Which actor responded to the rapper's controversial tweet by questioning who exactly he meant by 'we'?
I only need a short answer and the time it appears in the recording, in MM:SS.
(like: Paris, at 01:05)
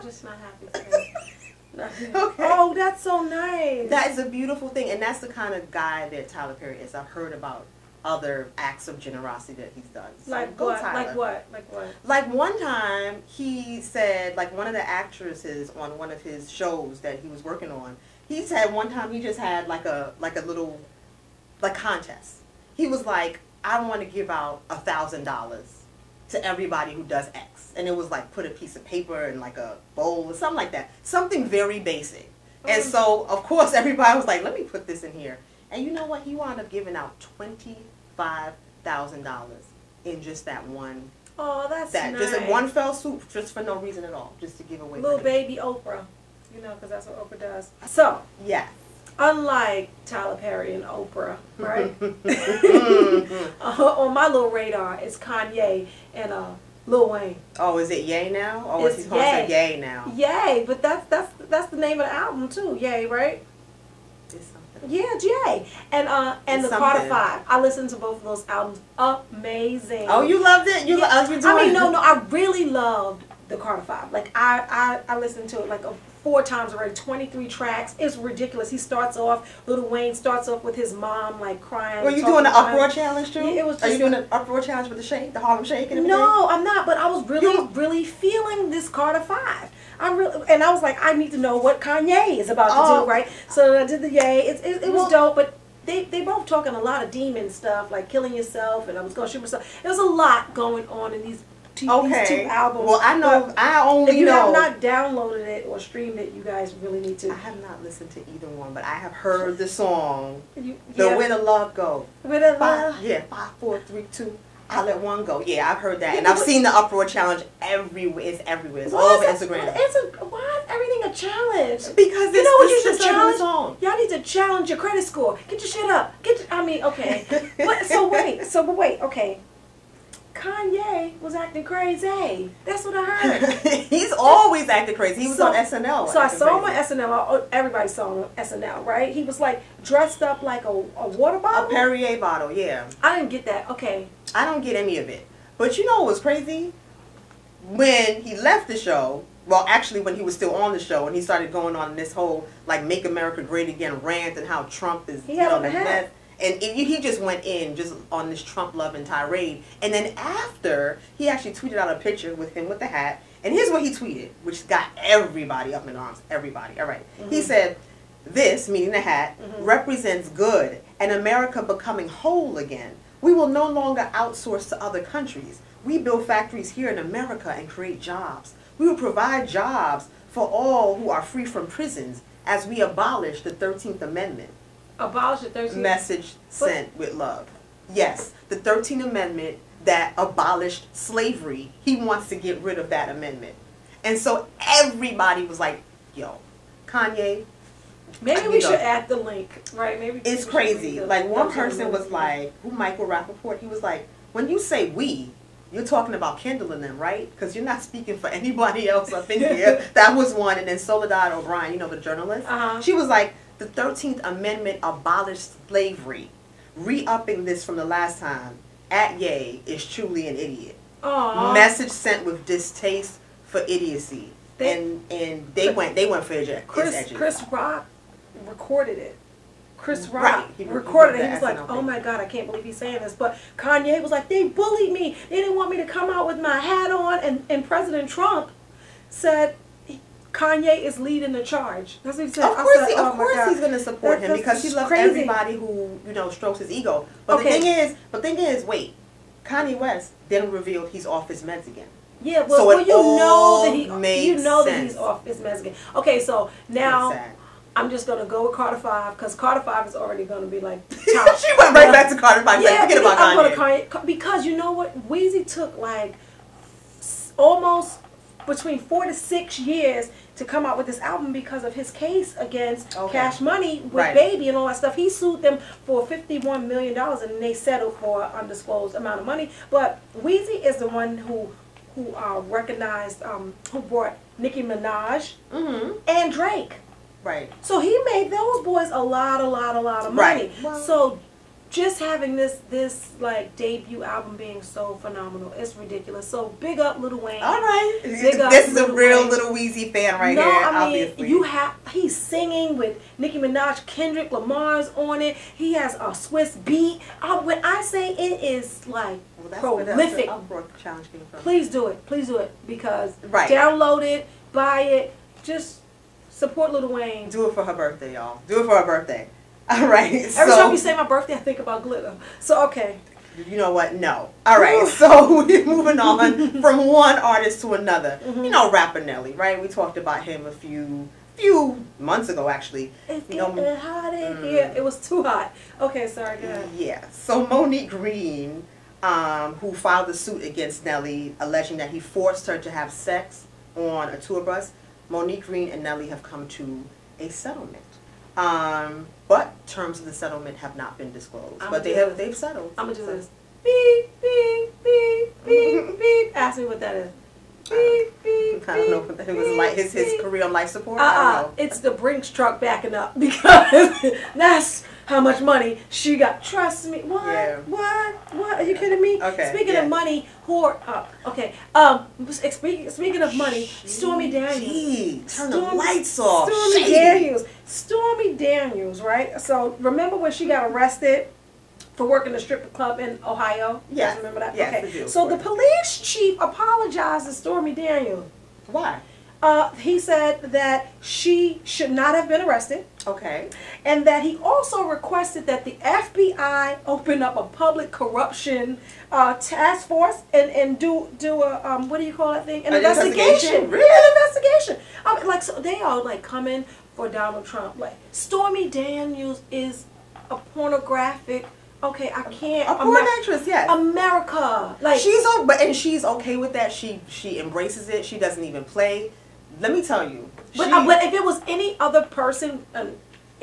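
Michael Rapaport, at 03:22.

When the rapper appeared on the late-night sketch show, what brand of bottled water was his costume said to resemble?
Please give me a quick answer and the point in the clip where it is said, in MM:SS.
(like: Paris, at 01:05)
Perrier, at 02:21.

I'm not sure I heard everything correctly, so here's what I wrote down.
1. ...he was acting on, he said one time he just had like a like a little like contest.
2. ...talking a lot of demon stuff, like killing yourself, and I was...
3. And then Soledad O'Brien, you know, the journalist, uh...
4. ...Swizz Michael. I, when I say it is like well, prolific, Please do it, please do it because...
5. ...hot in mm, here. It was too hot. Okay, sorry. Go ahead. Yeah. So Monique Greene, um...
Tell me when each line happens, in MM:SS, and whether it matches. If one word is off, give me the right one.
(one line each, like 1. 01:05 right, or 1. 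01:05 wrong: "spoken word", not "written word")
1. 00:17 wrong: "working", not "acting"
2. 01:36 right
3. 03:30 right
4. 05:06 wrong: "Beatz", not "Michael"
5. 05:33 right.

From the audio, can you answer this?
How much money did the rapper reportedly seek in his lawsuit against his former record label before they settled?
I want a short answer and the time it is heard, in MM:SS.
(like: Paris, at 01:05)
$51 million, at 04:36.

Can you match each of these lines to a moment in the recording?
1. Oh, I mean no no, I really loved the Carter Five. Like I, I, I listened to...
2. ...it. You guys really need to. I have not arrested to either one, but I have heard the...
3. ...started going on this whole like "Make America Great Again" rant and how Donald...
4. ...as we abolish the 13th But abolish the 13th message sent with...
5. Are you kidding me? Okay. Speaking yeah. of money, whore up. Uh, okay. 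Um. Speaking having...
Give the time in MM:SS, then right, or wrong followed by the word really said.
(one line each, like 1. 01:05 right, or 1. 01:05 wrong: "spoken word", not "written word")
1. 01:11 right
2. 01:46 wrong: "listened", not "arrested"
3. 02:31 wrong: "Trump", not "Donald"
4. 03:02 wrong: "Amendment", not "But"
5. 06:08 wrong: "speaking", not "having".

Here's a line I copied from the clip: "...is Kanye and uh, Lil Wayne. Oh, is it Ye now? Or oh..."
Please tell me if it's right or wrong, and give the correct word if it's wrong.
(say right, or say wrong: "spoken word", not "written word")
right.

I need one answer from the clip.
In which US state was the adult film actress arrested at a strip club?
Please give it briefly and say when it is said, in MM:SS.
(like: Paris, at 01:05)
Ohio, at 06:23.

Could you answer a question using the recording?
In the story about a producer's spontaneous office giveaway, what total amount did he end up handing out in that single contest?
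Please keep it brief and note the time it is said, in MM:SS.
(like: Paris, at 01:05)
$25,000, at 00:37.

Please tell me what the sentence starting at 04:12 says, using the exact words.
Yeah, well, so well you know that he you know sense.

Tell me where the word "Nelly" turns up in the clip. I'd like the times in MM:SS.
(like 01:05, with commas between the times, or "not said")
05:28, 05:40, 05:45.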